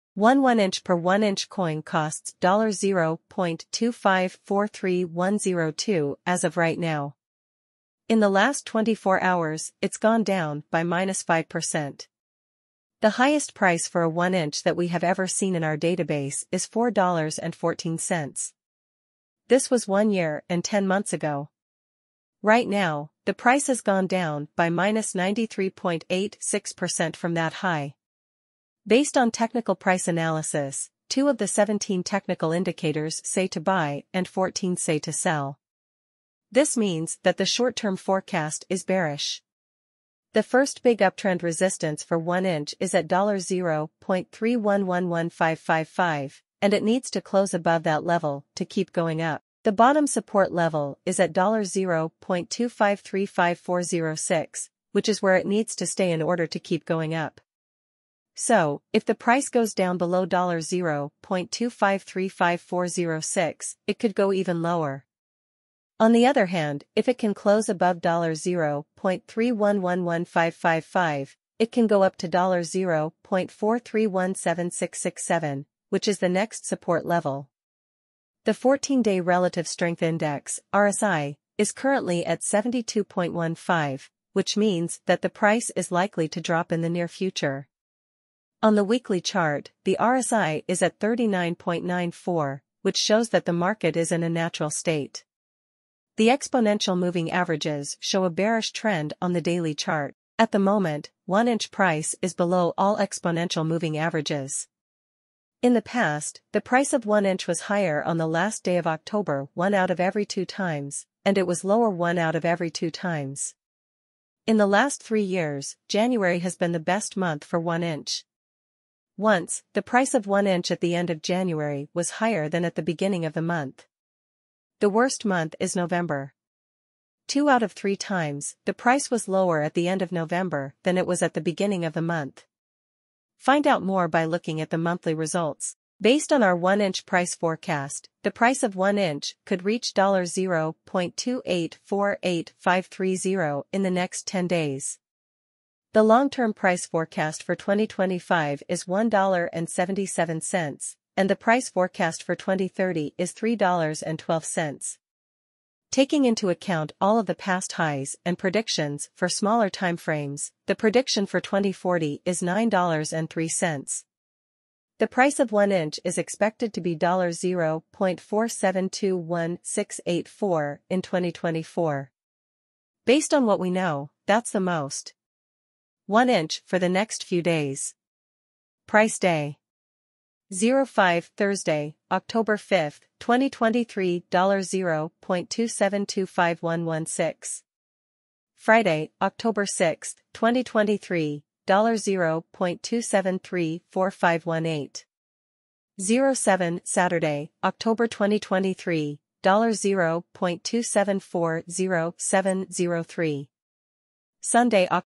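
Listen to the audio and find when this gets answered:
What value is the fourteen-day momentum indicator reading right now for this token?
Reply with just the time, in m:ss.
1:22.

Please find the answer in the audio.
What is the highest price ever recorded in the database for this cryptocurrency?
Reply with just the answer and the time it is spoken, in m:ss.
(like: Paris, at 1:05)
$4.14, at 0:16.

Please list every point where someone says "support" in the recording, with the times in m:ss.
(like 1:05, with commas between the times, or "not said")
0:50, 1:16.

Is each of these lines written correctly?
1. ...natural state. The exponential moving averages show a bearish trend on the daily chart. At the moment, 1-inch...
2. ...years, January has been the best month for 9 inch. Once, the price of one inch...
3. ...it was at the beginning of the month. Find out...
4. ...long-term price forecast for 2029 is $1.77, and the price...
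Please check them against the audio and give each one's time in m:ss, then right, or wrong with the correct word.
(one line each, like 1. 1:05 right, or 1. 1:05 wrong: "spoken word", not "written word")
1. 1:34 right
2. 1:55 wrong: "1", not "9"
3. 2:10 right
4. 2:26 wrong: "2025", not "2029".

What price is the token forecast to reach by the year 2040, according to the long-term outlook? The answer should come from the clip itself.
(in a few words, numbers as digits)
$9.03.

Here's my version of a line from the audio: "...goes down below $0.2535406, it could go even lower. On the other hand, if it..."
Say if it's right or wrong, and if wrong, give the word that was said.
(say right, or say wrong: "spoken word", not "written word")
right.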